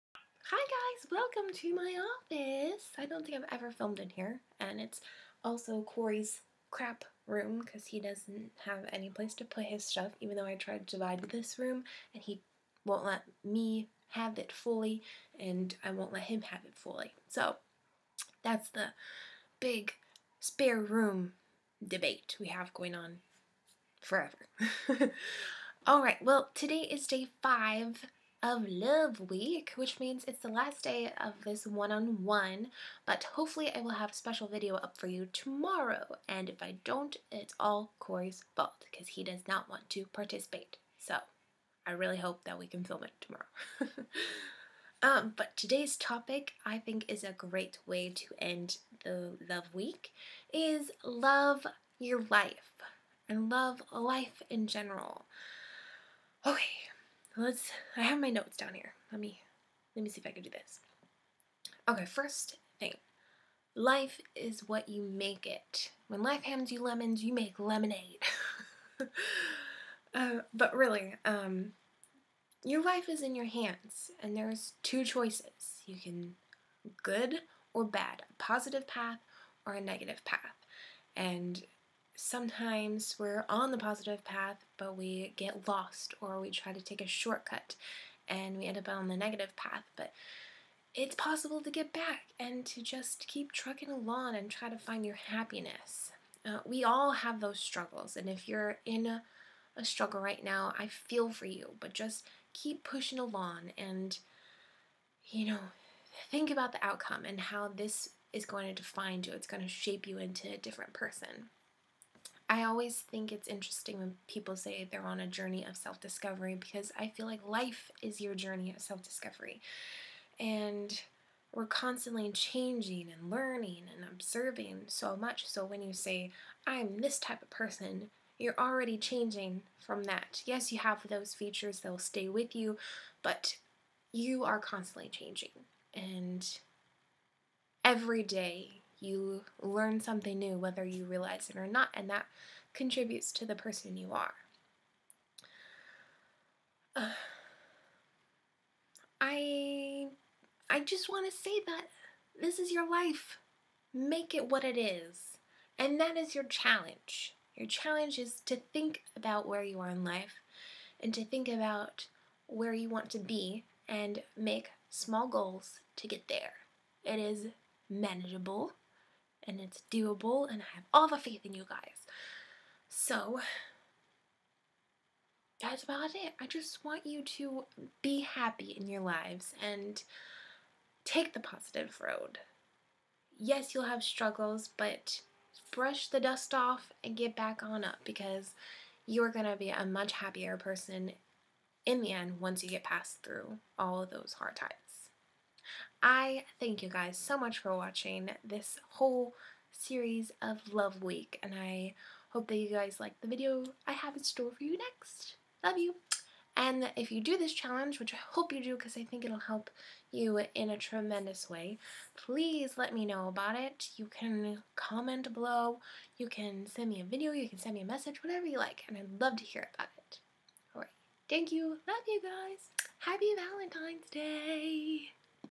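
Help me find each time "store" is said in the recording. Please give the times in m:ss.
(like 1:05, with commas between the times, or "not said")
3:24.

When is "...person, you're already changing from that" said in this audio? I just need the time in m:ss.
2:07.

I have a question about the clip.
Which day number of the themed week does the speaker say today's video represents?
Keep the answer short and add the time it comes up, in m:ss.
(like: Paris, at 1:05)
5, at 0:27.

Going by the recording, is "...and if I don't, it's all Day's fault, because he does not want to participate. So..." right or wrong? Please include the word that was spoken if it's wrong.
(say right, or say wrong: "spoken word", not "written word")
wrong: "Cory", not "Day".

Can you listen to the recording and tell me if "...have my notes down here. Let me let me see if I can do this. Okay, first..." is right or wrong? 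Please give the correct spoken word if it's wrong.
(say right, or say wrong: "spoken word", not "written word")
right.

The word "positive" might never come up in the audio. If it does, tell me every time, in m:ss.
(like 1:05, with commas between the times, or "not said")
1:18, 1:23, 3:01.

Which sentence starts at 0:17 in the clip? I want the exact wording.
So that's the big spare room debate we have going on forever.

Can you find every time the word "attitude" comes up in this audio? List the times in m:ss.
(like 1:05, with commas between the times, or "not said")
not said.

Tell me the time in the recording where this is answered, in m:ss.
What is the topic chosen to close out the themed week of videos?
0:51.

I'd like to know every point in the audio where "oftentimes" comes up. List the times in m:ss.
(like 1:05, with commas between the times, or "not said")
not said.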